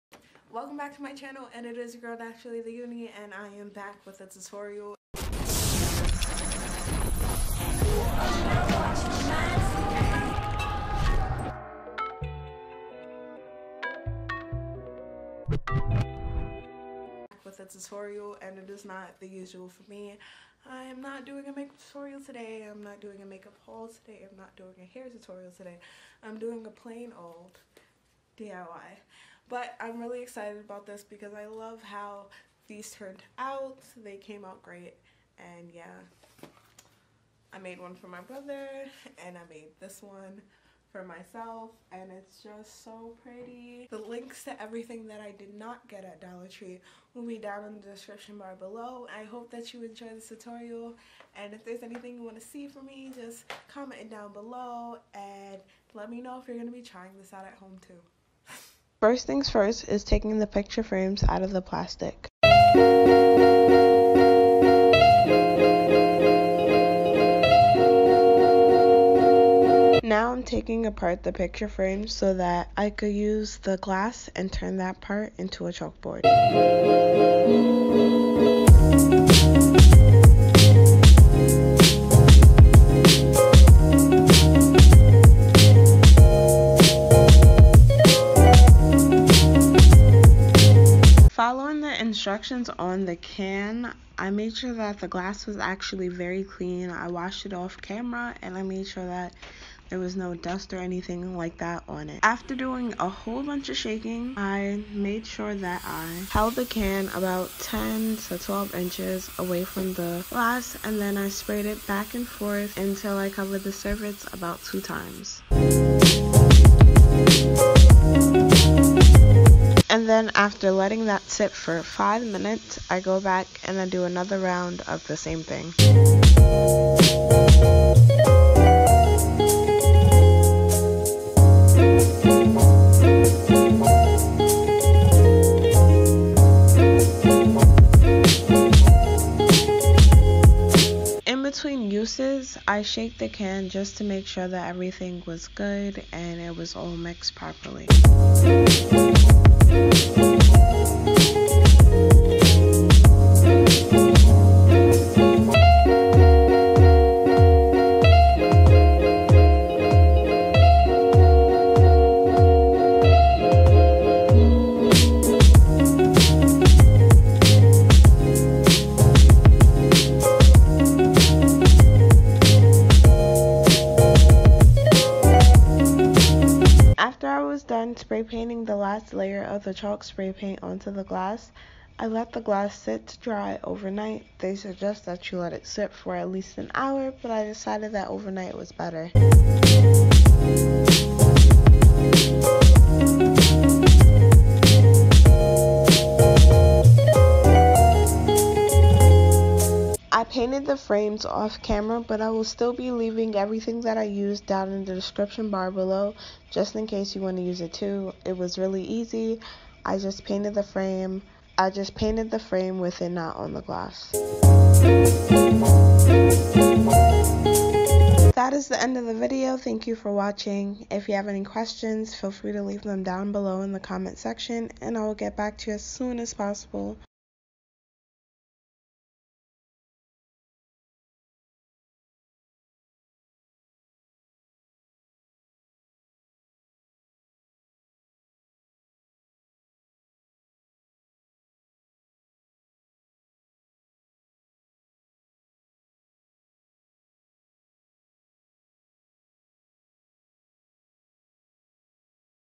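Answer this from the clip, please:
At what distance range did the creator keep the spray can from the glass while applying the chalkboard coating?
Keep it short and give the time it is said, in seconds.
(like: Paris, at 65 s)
10 to 12 inches, at 107 s.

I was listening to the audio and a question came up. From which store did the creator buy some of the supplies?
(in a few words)
Dollar Tree.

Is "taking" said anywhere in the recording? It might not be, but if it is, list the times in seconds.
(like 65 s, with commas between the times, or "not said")
60 s, 70 s.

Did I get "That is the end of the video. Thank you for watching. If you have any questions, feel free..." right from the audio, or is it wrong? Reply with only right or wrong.
right.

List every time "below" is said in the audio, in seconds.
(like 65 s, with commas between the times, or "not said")
48 s, 54 s, 205 s, 223 s.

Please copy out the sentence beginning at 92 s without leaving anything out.
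instructions on the can, I made sure that the glass was actually very clean.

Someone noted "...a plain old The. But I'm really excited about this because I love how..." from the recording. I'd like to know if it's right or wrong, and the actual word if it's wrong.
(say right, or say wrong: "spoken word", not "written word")
wrong: "DIY", not "The".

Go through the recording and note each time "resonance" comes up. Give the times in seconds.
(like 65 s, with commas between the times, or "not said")
not said.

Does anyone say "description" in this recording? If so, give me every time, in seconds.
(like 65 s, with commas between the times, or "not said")
47 s, 204 s.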